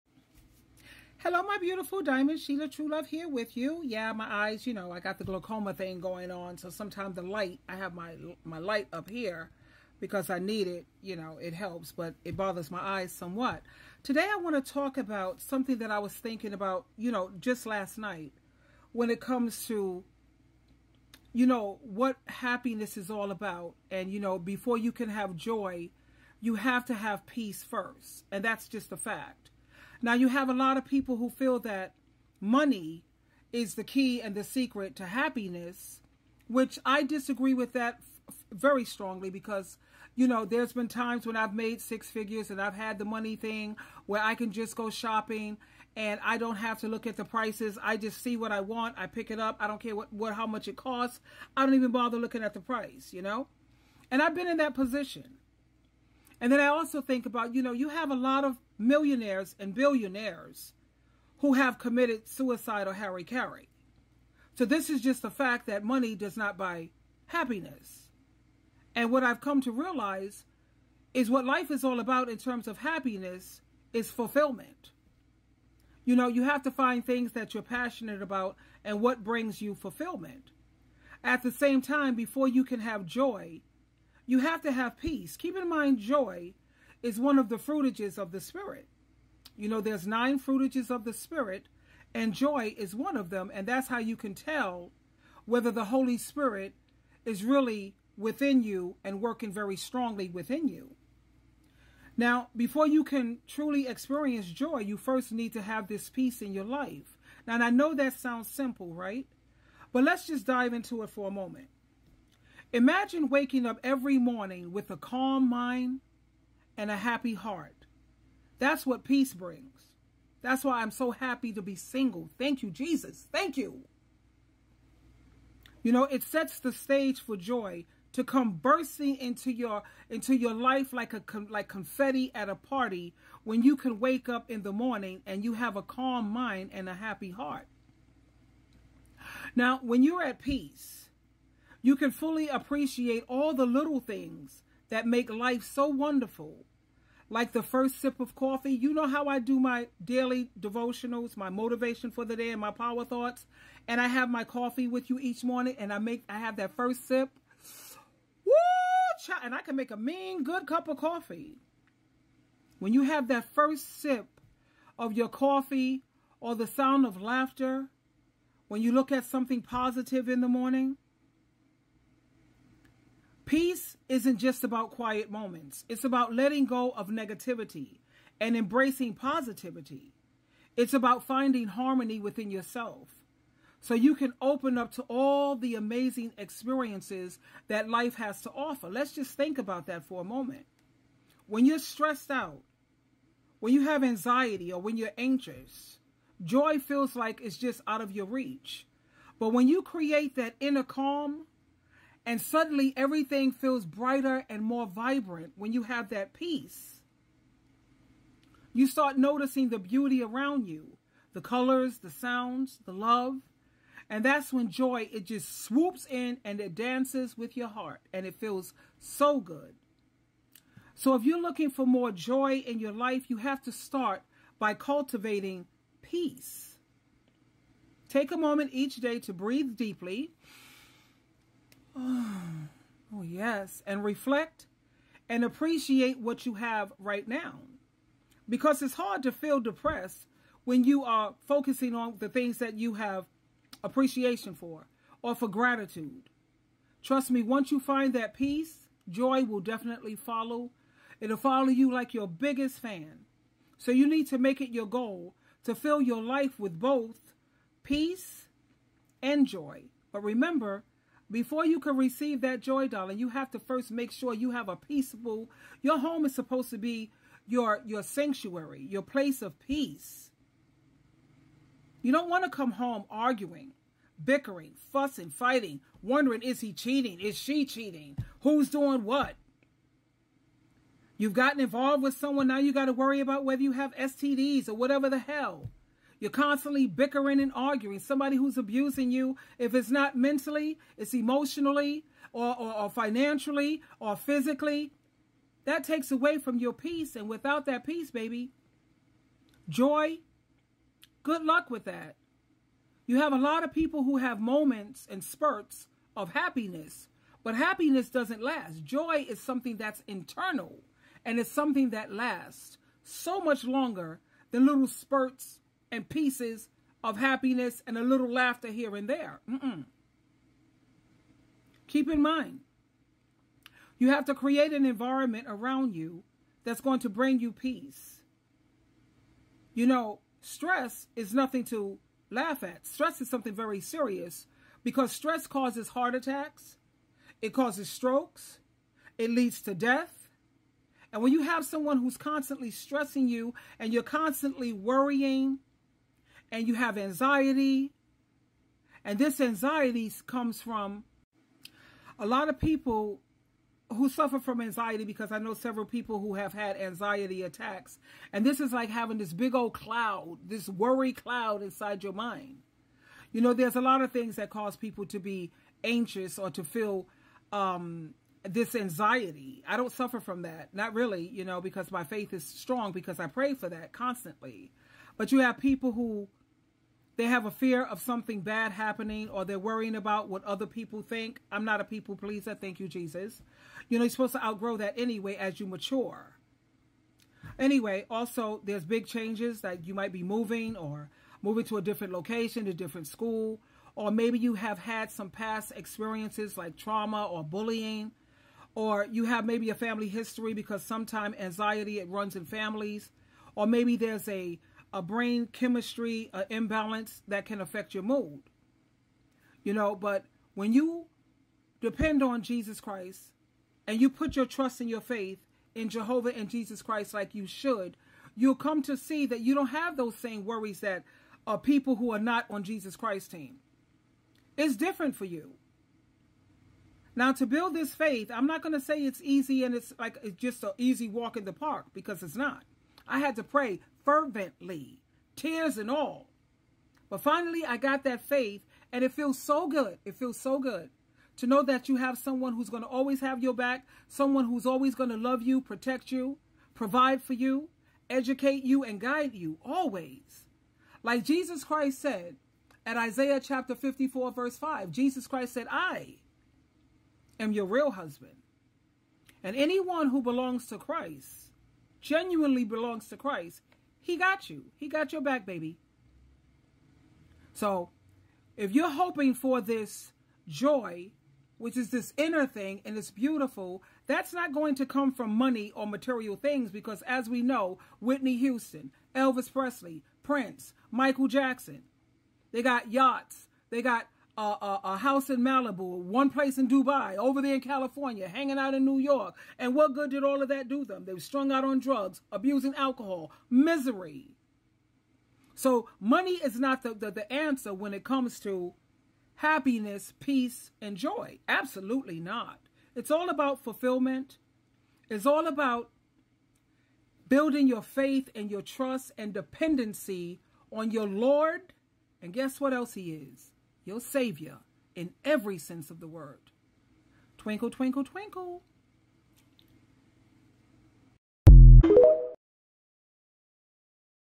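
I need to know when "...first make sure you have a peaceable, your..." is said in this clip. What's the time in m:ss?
4:23.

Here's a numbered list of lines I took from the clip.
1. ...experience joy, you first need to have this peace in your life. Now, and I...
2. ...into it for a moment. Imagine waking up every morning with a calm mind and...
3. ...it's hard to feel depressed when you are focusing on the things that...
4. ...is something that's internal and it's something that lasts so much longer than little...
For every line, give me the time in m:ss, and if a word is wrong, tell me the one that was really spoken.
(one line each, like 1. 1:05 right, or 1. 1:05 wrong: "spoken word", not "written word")
1. 1:43 right
2. 1:50 right
3. 3:58 right
4. 5:09 right.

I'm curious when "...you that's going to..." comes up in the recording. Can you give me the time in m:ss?
5:25.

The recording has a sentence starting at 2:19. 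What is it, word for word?
Now, when you're at peace, you can fully appreciate all the little things that make life so wonderful.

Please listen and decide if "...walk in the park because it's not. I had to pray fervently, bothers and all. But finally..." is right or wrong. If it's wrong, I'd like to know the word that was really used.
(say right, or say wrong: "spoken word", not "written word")
wrong: "tears", not "bothers".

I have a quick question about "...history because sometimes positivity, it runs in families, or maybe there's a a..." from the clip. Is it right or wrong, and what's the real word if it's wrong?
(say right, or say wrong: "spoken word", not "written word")
wrong: "anxiety", not "positivity".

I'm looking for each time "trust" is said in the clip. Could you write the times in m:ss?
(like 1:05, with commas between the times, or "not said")
4:07, 6:54, 8:28.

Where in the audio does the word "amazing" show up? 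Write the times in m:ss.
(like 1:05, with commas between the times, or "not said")
3:05.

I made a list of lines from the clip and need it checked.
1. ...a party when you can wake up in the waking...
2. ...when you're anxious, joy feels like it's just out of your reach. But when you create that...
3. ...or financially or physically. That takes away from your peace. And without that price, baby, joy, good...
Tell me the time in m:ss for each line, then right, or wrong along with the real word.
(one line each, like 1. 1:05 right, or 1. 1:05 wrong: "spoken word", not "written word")
1. 2:12 wrong: "morning", not "waking"
2. 3:14 right
3. 4:52 wrong: "peace", not "price".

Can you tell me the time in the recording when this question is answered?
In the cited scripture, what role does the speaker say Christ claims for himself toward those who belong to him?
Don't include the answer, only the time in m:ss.
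7:37.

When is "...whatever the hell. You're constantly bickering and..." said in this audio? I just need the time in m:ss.
4:44.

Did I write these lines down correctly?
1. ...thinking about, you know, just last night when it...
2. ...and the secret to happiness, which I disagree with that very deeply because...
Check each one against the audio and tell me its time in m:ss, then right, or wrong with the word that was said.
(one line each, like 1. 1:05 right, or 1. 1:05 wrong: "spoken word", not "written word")
1. 0:16 right
2. 0:34 wrong: "strongly", not "deeply".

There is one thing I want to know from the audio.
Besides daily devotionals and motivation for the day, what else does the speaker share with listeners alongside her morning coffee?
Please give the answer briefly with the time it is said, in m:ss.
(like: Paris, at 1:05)
power thoughts, at 2:32.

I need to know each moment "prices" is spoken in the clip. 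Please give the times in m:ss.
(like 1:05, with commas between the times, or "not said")
0:47, 0:52.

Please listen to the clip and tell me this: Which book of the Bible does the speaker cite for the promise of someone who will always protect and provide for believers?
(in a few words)
Isaiah.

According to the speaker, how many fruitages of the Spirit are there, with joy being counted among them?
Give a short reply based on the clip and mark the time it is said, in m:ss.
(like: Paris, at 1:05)
9, at 1:30.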